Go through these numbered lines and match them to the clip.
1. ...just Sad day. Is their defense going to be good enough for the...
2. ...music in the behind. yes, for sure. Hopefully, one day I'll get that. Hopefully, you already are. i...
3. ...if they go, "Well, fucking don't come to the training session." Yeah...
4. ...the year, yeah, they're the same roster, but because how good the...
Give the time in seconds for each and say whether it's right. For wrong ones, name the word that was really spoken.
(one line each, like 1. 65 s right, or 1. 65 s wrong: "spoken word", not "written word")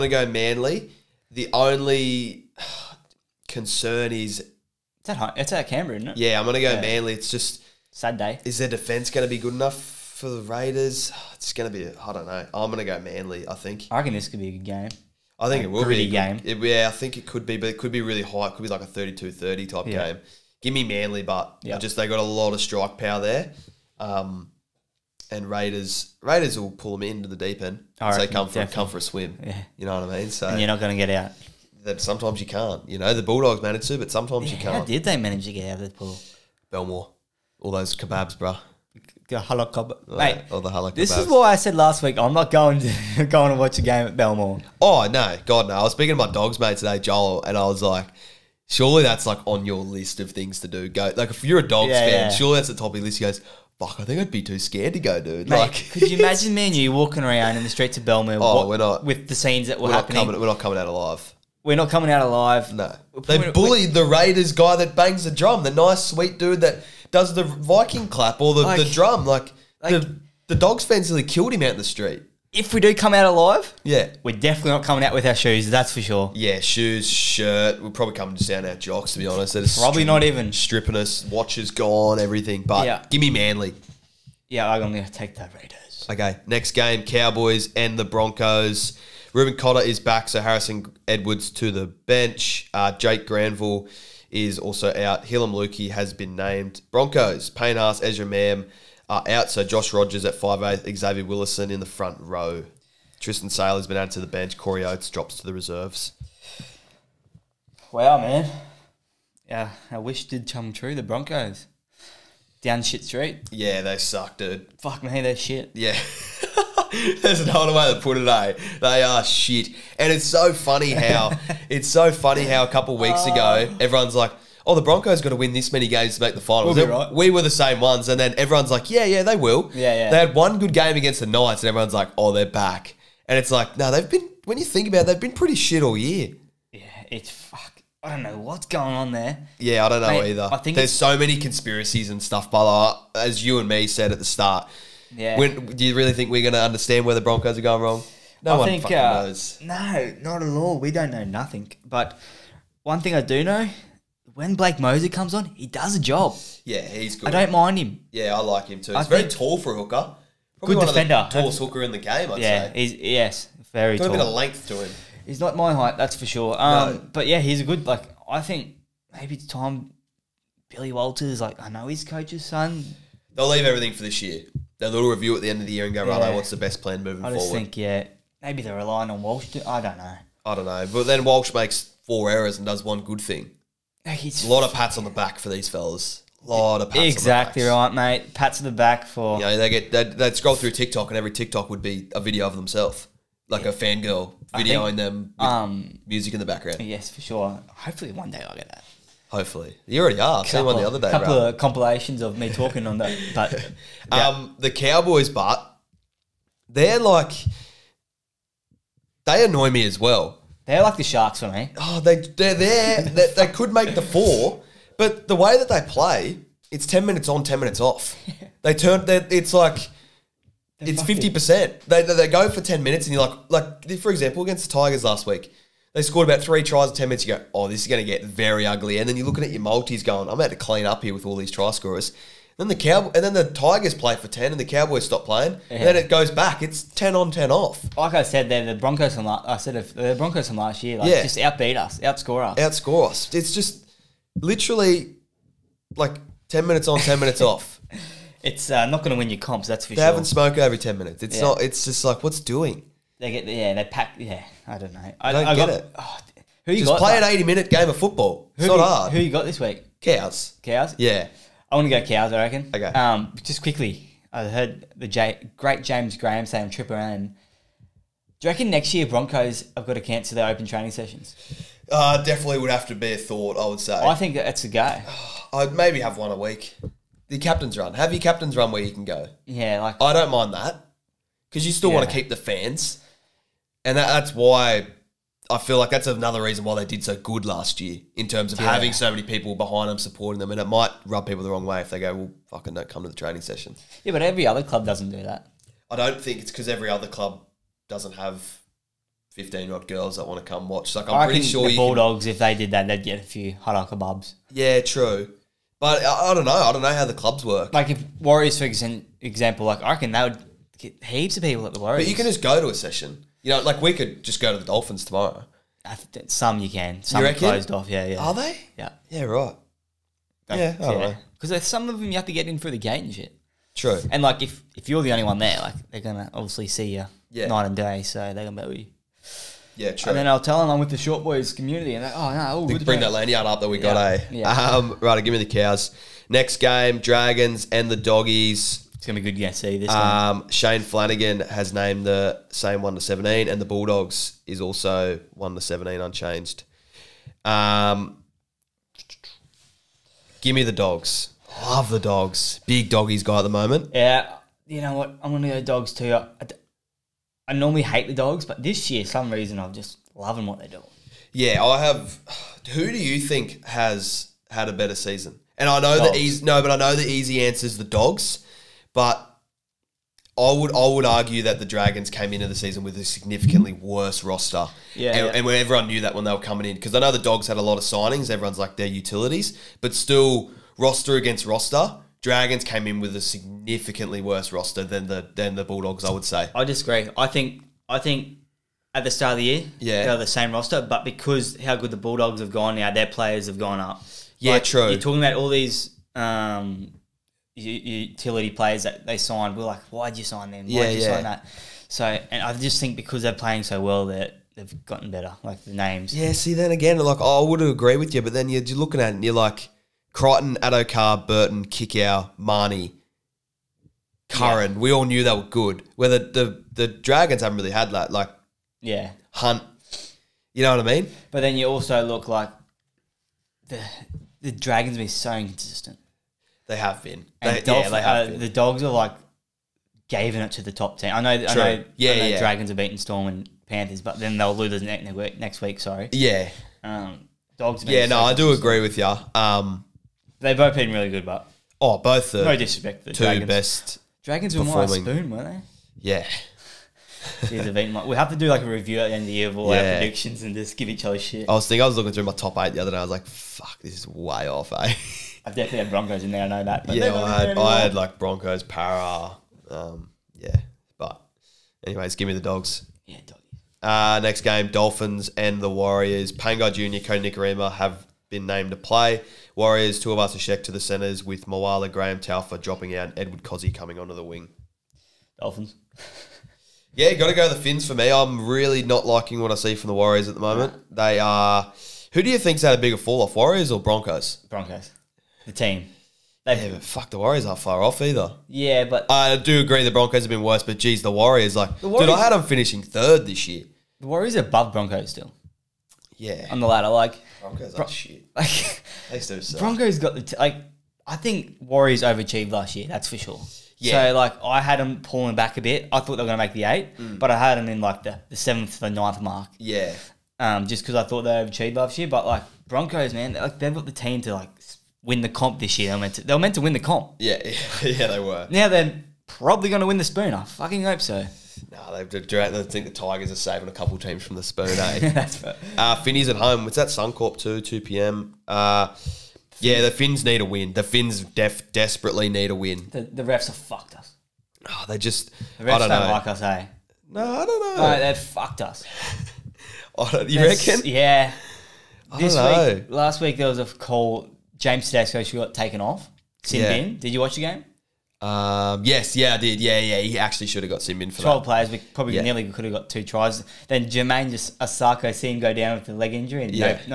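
1. 7 s right
2. 196 s wrong: "background", not "behind"
3. 291 s right
4. 389 s right.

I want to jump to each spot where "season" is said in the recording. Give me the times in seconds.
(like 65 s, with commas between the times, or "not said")
364 s, 372 s.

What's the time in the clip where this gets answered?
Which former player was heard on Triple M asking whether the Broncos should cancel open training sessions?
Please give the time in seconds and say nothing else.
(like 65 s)
265 s.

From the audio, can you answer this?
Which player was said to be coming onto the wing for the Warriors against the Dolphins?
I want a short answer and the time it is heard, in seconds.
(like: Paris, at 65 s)
Edward Kosi, at 473 s.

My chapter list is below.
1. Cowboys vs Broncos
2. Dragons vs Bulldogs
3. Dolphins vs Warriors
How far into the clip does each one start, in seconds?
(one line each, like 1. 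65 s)
1. 85 s
2. 335 s
3. 463 s.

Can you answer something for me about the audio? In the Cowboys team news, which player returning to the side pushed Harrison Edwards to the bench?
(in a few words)
Reuben Cotter.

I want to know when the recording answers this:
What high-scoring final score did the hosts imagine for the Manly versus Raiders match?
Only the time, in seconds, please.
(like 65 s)
18 s.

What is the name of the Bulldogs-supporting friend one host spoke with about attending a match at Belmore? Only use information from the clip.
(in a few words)
Joel.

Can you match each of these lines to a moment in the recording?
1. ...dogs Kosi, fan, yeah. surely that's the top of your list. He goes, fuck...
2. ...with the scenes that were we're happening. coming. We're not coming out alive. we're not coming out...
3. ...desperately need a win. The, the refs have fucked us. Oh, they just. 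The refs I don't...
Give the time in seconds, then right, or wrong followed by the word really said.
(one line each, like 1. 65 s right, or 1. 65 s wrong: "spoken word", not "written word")
1. 51 s wrong: "Yeah", not "Kosi"
2. 59 s right
3. 531 s right.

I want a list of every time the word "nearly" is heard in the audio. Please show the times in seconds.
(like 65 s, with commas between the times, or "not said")
71 s, 552 s.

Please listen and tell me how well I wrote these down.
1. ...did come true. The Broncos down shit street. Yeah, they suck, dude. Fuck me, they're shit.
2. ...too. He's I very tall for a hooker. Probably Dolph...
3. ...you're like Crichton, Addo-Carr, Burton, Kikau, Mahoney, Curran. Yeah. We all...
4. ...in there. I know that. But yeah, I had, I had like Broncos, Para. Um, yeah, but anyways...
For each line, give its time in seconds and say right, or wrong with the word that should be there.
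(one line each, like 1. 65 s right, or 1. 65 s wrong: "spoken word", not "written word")
1. 110 s right
2. 158 s wrong: "Good", not "Dolph"
3. 409 s right
4. 456 s right.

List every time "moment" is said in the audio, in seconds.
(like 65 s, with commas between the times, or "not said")
353 s, 480 s.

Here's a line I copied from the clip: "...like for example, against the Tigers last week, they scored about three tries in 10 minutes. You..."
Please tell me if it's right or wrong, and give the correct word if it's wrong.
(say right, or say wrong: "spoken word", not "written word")
right.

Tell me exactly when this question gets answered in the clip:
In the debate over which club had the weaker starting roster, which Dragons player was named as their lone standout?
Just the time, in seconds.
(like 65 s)
419 s.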